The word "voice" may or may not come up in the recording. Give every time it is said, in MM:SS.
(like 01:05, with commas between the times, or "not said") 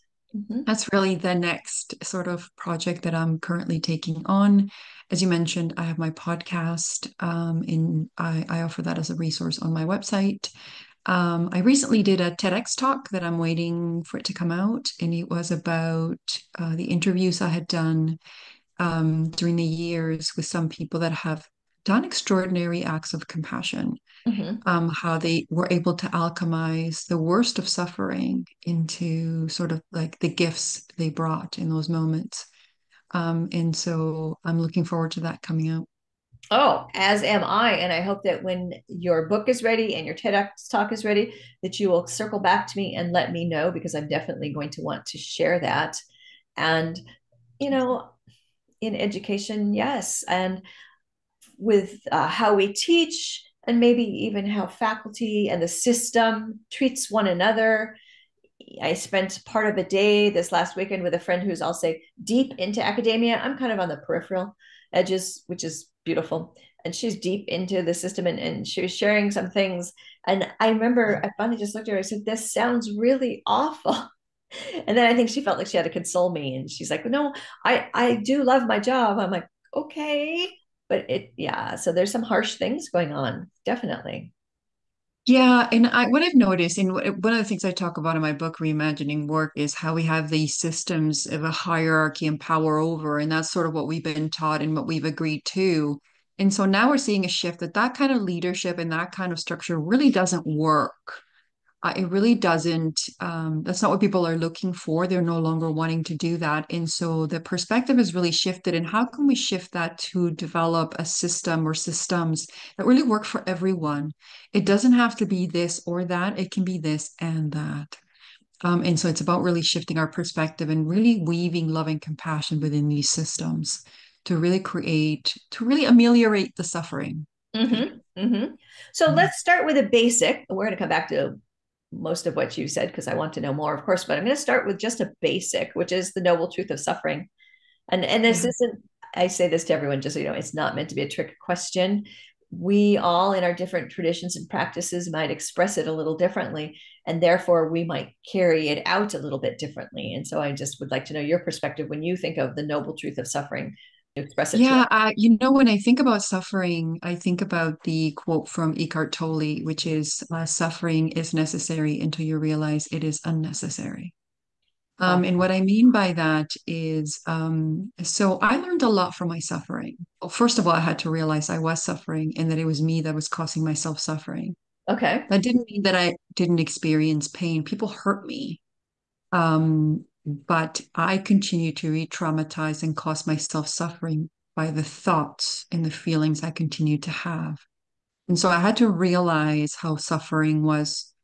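not said.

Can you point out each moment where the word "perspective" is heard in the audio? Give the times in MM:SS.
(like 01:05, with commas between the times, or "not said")
01:47, 02:00, 02:31.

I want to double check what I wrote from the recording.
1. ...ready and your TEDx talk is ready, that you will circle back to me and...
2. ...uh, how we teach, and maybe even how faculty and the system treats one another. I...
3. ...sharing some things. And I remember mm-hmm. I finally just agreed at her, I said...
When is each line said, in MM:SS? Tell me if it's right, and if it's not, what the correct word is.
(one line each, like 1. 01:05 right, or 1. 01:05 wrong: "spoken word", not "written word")
1. 00:39 right
2. 00:52 right
3. 01:08 wrong: "looked", not "agreed".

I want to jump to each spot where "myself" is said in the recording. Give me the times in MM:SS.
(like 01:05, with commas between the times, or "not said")
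02:53, 03:03.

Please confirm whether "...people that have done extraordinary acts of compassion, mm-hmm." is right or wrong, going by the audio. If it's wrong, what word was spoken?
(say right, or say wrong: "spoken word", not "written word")
right.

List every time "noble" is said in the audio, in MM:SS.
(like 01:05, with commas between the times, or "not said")
02:16, 02:32.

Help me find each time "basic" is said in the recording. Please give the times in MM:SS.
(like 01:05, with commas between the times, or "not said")
02:09, 02:15.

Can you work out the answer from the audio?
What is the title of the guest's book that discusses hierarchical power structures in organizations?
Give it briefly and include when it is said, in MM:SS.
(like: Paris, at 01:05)
Reimagining Work, at 01:28.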